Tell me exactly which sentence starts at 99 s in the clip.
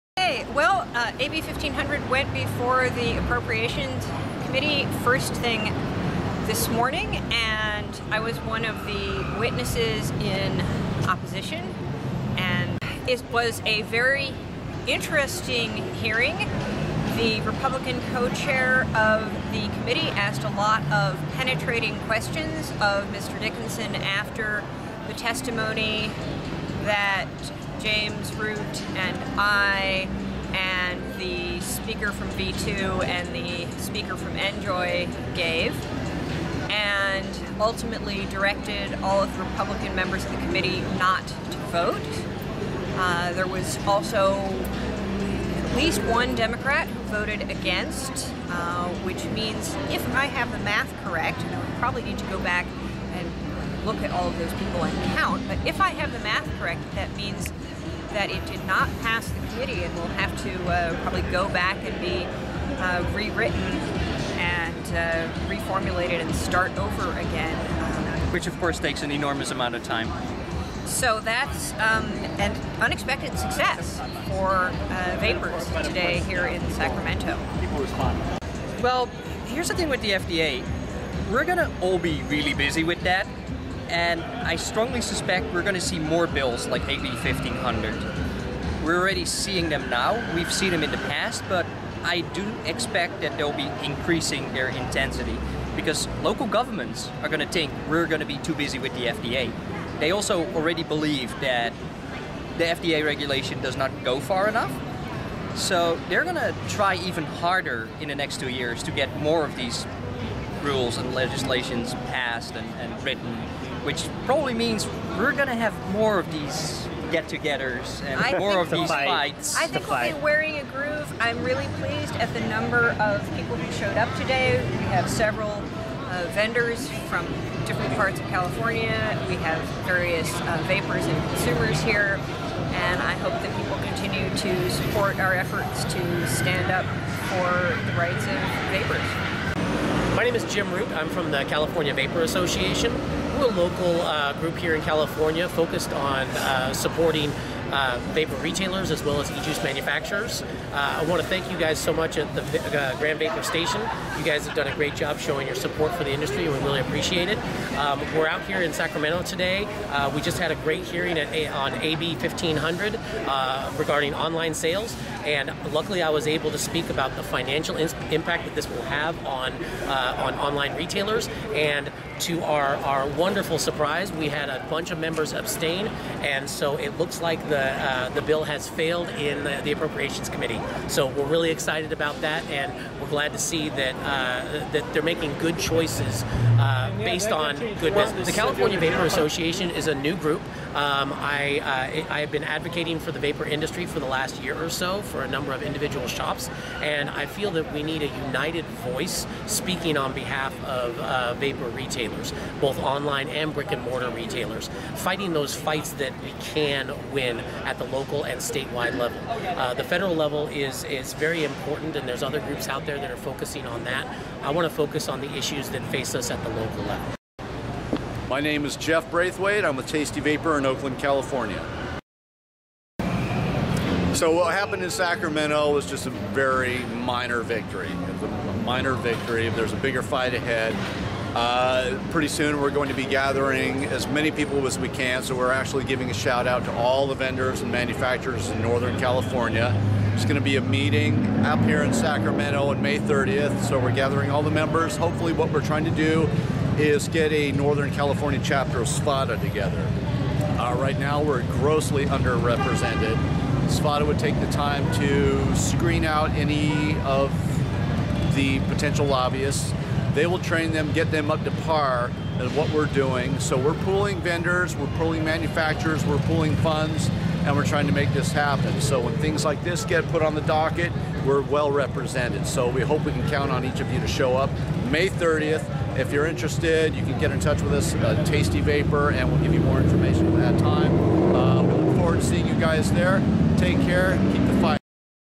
They also already believe that the FDA regulation does not go far enough.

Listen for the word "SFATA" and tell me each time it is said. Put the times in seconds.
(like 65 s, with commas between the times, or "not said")
248 s, 253 s.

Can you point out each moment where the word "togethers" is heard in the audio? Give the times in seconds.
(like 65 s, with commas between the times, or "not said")
117 s, 249 s.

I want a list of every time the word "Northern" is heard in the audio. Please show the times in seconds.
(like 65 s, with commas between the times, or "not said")
238 s, 247 s.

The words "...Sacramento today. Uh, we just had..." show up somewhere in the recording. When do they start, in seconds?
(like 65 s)
158 s.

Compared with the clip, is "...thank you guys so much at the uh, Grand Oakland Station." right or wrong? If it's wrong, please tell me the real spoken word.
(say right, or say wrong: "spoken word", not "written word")
wrong: "Vapor", not "Oakland".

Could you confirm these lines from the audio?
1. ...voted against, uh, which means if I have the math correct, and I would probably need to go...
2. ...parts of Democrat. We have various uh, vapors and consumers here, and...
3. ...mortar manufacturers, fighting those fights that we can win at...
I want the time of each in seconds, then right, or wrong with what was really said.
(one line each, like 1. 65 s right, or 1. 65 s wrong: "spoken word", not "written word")
1. 47 s right
2. 127 s wrong: "California", not "Democrat"
3. 203 s wrong: "retailers", not "manufacturers".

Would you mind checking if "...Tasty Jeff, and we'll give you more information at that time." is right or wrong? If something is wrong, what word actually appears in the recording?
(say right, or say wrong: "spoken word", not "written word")
wrong: "Vapor", not "Jeff".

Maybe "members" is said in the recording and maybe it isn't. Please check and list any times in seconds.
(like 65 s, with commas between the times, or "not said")
39 s, 174 s, 244 s.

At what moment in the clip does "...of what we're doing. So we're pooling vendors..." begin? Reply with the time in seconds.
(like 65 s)
262 s.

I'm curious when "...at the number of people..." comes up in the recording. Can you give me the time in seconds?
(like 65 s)
122 s.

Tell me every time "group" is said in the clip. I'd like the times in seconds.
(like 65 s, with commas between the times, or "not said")
144 s, 190 s, 212 s.